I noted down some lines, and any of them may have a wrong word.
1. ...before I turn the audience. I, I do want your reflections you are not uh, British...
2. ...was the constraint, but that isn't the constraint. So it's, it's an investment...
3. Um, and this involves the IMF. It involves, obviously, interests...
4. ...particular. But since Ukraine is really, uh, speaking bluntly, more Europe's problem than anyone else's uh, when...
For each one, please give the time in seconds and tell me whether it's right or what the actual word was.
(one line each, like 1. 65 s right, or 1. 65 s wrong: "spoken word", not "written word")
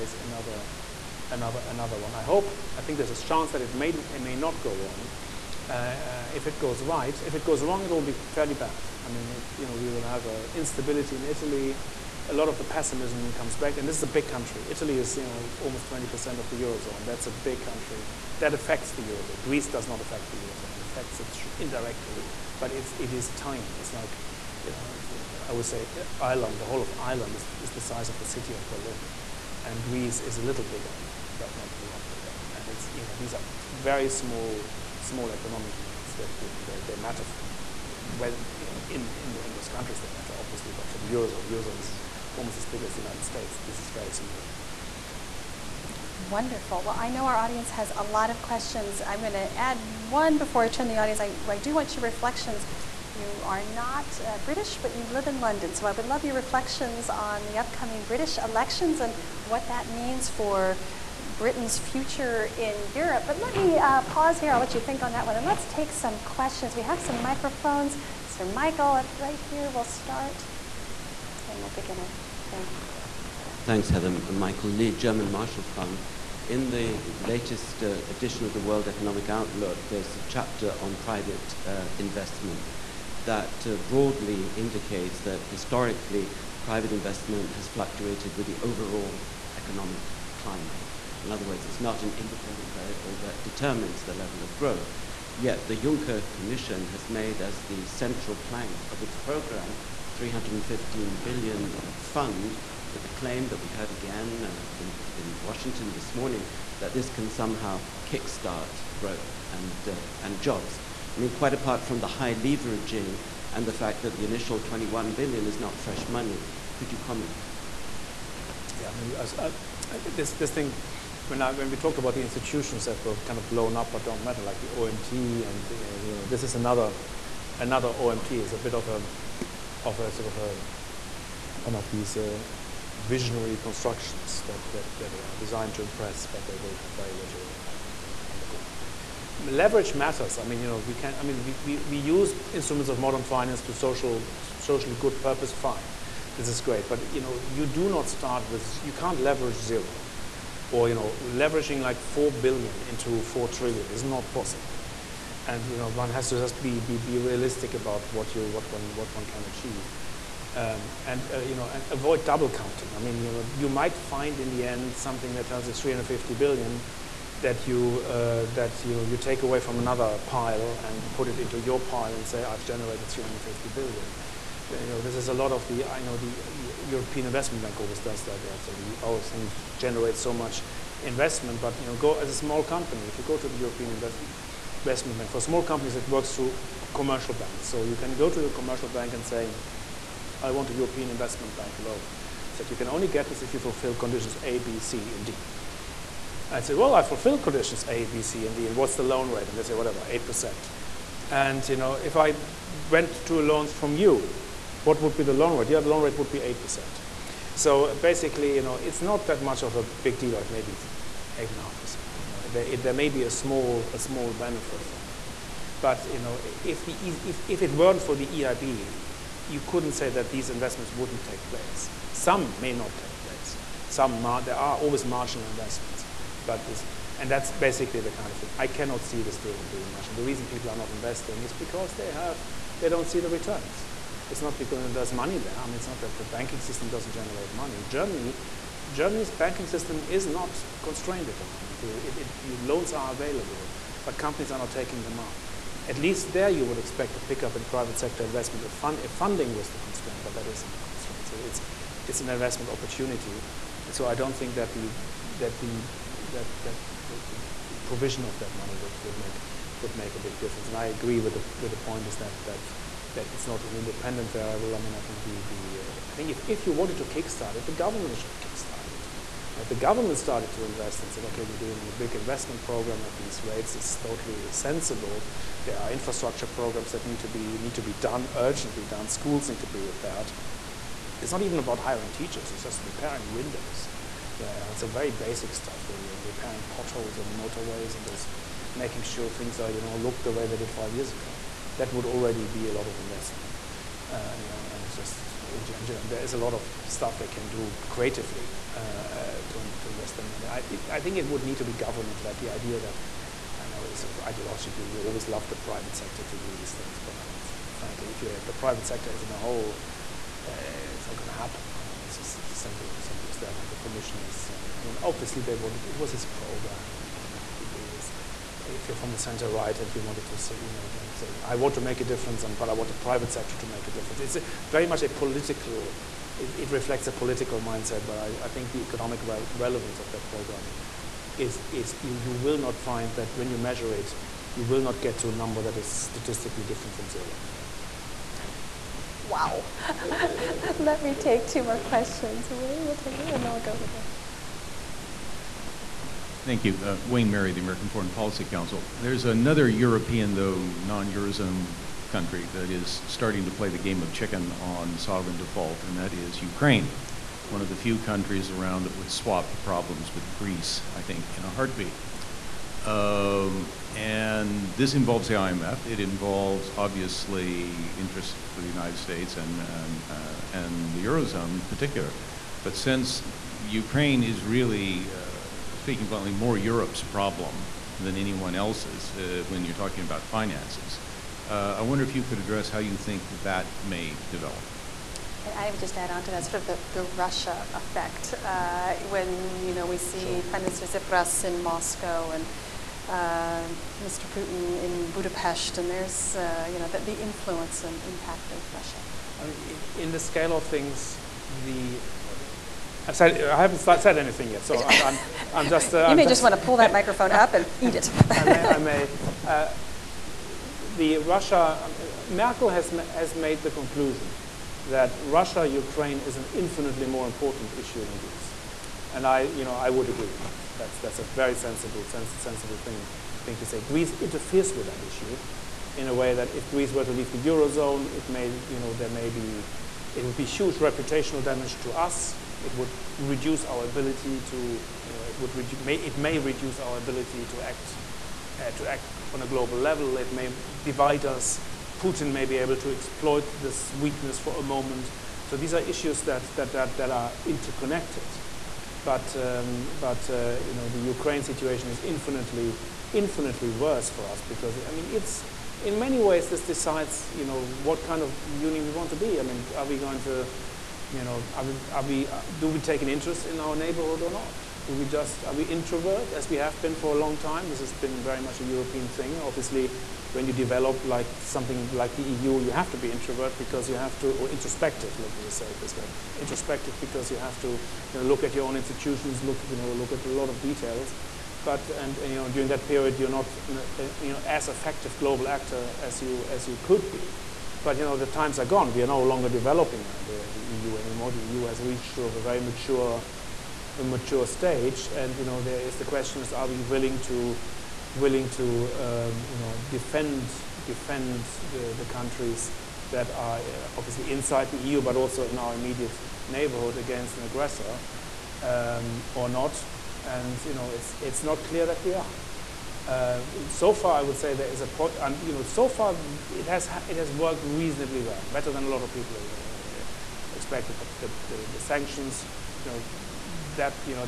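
1. 50 s right
2. 249 s right
3. 362 s right
4. 371 s right.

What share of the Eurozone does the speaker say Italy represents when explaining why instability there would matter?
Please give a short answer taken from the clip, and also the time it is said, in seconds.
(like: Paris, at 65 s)
almost 20%, at 15 s.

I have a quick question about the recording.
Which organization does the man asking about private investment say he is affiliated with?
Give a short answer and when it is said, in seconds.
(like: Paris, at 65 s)
German Marshall Fund, at 74 s.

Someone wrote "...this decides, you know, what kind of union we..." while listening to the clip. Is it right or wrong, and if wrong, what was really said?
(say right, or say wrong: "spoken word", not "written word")
right.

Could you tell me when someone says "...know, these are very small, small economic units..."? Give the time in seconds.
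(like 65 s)
33 s.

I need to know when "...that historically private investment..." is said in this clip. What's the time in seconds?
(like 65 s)
85 s.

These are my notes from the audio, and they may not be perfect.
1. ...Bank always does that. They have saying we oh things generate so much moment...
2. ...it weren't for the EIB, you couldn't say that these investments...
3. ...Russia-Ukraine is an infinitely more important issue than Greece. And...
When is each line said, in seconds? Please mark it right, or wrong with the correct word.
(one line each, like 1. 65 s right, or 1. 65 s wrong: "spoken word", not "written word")
1. 177 s wrong: "investment", not "moment"
2. 217 s right
3. 415 s right.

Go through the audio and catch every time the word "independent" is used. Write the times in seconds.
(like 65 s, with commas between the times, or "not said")
92 s, 263 s.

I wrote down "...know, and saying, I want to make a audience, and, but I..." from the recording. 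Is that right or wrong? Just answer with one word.
wrong.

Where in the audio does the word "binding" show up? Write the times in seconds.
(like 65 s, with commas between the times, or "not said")
not said.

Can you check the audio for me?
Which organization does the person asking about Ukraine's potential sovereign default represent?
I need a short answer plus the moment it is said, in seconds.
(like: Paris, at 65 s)
American Foreign Policy Council, at 347 s.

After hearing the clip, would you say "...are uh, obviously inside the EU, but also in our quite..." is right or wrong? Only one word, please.
wrong.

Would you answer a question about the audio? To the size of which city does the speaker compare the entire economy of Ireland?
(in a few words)
Berlin.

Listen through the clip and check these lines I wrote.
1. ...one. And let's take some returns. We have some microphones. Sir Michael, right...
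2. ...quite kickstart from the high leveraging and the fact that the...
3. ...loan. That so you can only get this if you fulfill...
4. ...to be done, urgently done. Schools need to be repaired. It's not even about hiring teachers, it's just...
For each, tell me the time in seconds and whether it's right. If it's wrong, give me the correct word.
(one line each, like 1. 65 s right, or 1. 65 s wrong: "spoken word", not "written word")
1. 65 s wrong: "questions", not "returns"
2. 111 s wrong: "apart", not "kickstart"
3. 191 s right
4. 277 s right.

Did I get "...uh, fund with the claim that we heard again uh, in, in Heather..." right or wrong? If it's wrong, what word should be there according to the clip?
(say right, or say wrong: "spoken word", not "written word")
wrong: "Washington", not "Heather".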